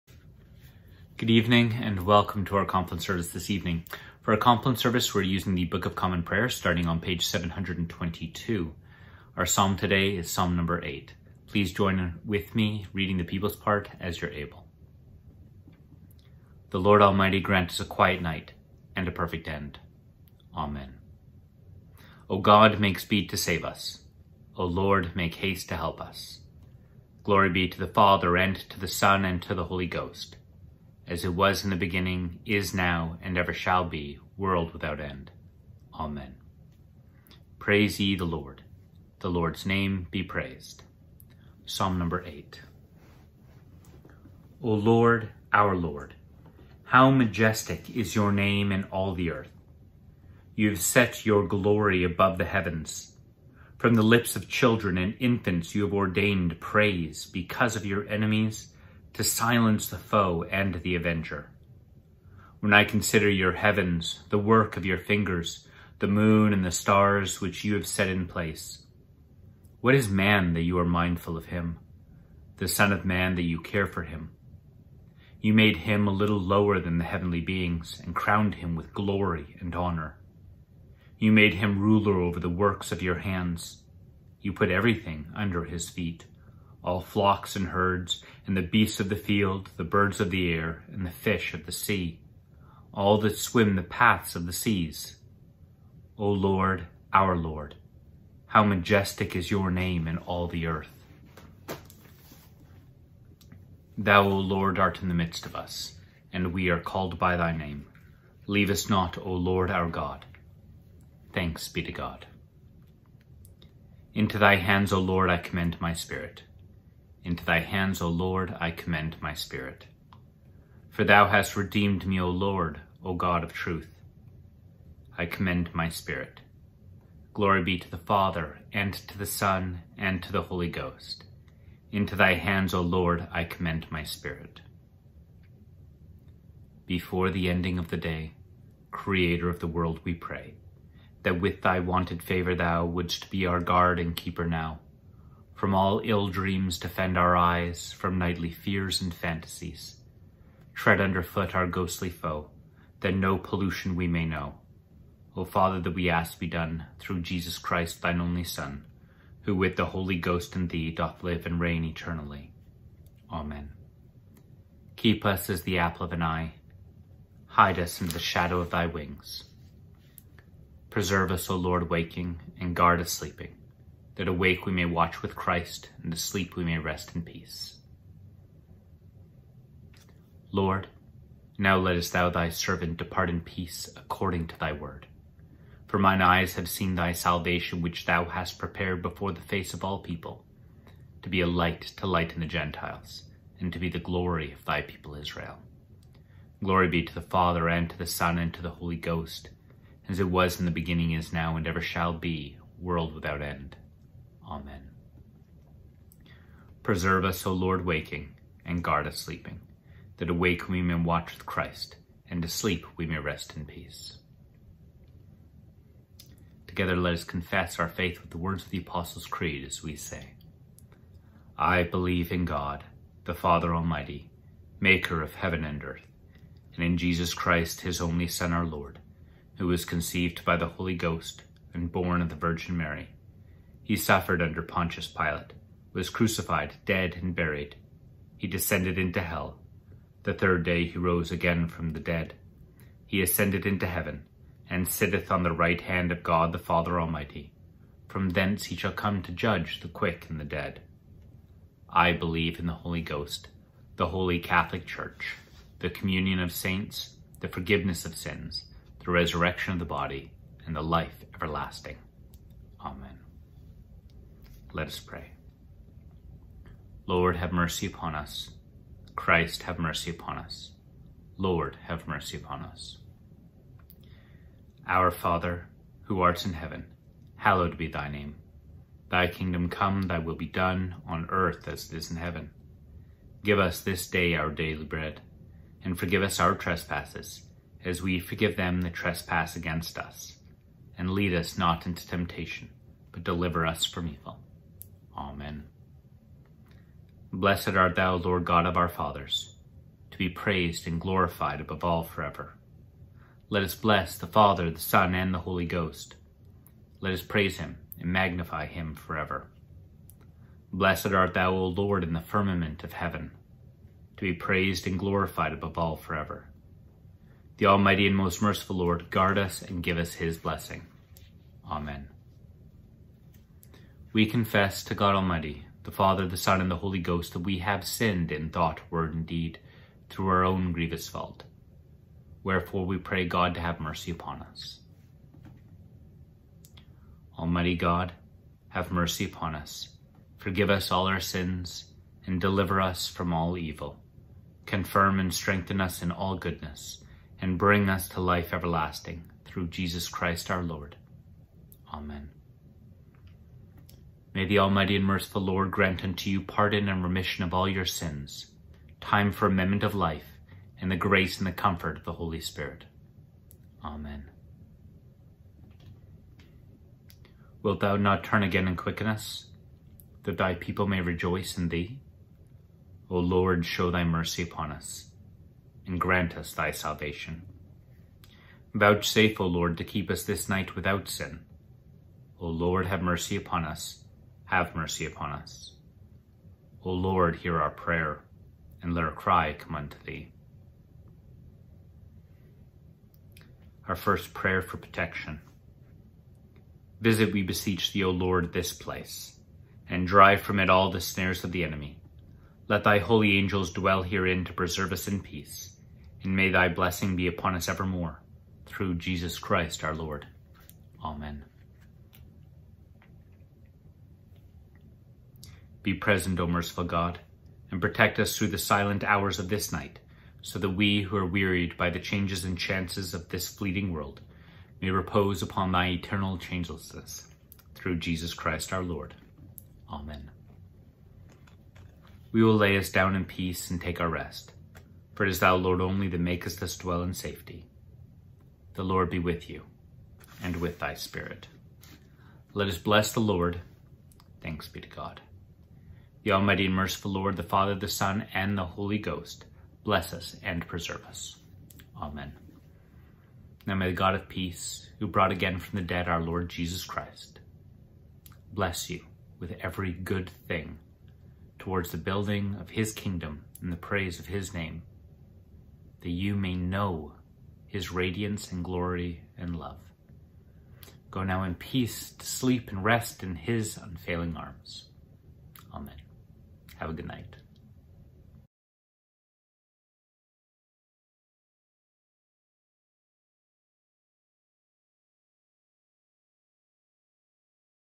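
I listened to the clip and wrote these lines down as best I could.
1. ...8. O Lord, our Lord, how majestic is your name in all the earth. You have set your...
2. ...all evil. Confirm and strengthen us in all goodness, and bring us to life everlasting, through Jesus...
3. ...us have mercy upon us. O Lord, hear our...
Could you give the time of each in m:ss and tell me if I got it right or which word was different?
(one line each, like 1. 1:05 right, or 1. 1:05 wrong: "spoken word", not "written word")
1. 0:42 right
2. 5:43 right
3. 6:23 right.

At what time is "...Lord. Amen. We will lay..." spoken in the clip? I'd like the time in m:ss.
7:08.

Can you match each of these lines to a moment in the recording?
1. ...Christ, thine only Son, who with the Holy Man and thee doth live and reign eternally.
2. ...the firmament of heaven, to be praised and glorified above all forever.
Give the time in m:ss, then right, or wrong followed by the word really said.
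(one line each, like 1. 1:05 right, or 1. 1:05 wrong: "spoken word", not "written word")
1. 2:37 wrong: "Ghost", not "Man"
2. 5:12 right.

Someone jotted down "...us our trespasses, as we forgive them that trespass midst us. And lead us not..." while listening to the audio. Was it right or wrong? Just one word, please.
wrong.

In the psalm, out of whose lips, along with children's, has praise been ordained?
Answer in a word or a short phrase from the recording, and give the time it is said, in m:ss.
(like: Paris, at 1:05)
infants, at 0:55.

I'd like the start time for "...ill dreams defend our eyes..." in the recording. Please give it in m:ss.
2:26.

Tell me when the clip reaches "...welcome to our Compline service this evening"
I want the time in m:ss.
0:02.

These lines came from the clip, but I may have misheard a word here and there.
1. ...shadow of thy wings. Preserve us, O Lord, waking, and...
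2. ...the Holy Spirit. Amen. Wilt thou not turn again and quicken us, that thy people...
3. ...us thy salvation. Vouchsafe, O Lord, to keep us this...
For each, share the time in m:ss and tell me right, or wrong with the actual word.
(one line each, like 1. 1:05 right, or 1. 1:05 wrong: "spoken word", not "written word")
1. 2:48 right
2. 6:02 right
3. 6:16 right.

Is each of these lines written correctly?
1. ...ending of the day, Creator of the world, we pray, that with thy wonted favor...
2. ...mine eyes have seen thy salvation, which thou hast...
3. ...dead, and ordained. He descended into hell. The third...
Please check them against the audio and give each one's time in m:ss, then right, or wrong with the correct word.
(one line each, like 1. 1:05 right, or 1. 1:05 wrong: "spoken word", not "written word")
1. 2:17 right
2. 3:05 right
3. 3:56 wrong: "buried", not "ordained".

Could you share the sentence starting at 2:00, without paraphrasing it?
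For thou hast redeemed me, O Lord, O God of truth.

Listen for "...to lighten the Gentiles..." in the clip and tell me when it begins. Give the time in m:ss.
3:11.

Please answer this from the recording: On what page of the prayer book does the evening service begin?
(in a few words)
722.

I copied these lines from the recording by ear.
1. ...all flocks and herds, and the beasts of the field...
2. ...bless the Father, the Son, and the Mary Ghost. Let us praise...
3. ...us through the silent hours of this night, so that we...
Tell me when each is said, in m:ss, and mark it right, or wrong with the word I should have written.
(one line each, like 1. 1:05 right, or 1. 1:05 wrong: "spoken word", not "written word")
1. 1:26 right
2. 5:03 wrong: "Holy", not "Mary"
3. 6:58 right.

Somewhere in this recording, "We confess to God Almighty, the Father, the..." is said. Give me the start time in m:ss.
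5:24.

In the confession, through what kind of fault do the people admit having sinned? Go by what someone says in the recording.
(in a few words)
grievous fault.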